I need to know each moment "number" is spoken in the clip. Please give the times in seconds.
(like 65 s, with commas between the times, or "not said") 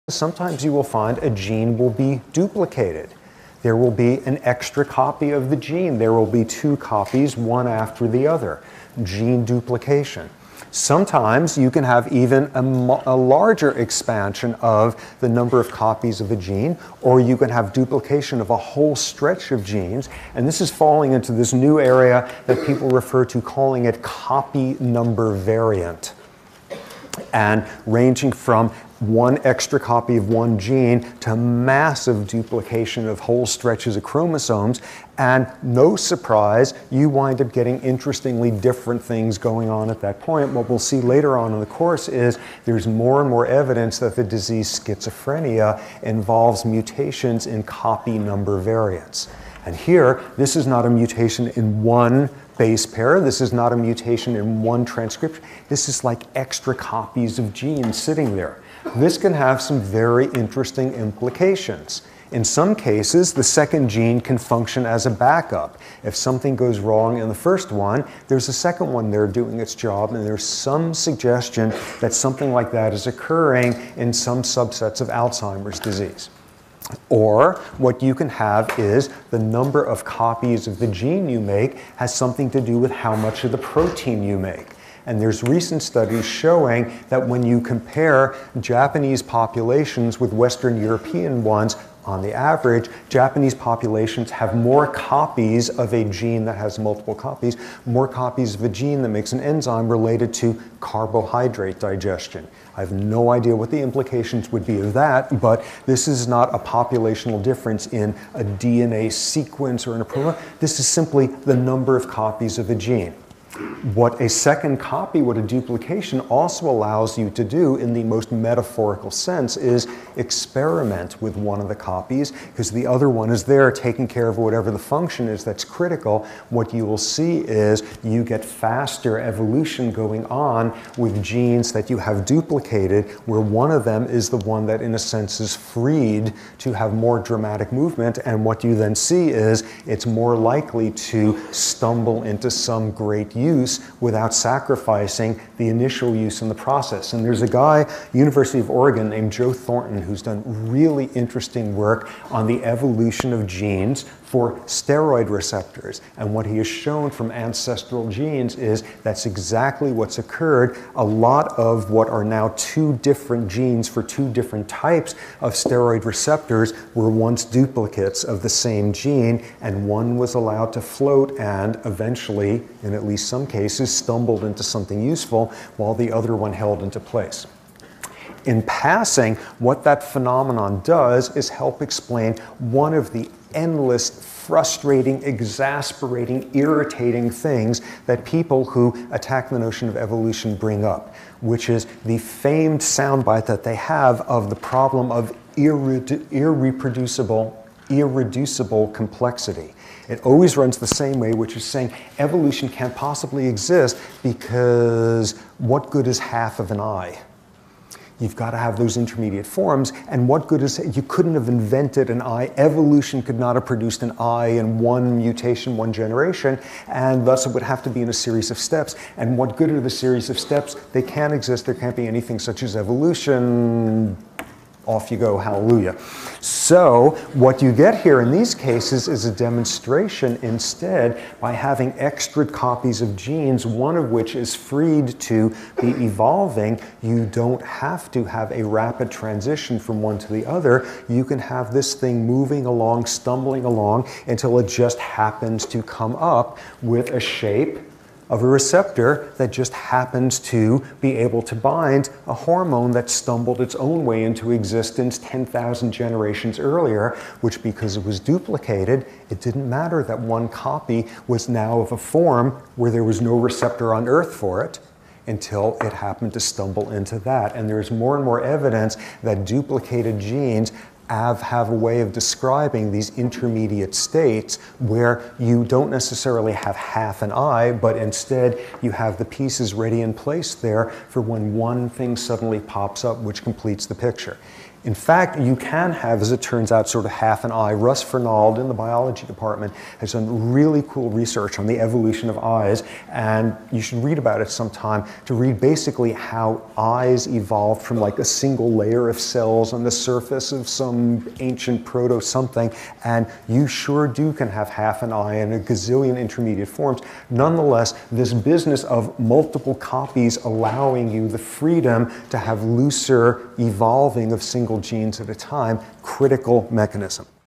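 15 s, 24 s, 48 s, 79 s, 111 s.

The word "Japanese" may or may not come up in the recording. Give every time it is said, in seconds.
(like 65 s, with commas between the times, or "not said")
88 s, 93 s.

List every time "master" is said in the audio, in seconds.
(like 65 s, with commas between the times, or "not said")
not said.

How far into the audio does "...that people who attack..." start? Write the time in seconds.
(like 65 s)
188 s.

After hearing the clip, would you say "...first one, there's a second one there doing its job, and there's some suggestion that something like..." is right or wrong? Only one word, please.
right.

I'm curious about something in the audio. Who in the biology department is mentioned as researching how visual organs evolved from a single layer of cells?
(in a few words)
Russ Fernald.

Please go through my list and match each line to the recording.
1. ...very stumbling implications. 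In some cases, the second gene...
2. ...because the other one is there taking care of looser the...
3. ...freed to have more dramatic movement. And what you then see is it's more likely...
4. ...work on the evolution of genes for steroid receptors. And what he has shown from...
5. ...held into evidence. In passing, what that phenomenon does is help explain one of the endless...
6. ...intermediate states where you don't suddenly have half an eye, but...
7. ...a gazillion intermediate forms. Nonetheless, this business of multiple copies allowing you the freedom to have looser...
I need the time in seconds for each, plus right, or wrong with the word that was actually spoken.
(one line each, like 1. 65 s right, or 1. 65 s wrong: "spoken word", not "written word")
1. 59 s wrong: "interesting", not "stumbling"
2. 122 s wrong: "whatever", not "looser"
3. 135 s right
4. 151 s right
5. 176 s wrong: "place", not "evidence"
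6. 273 s wrong: "necessarily", not "suddenly"
7. 305 s right.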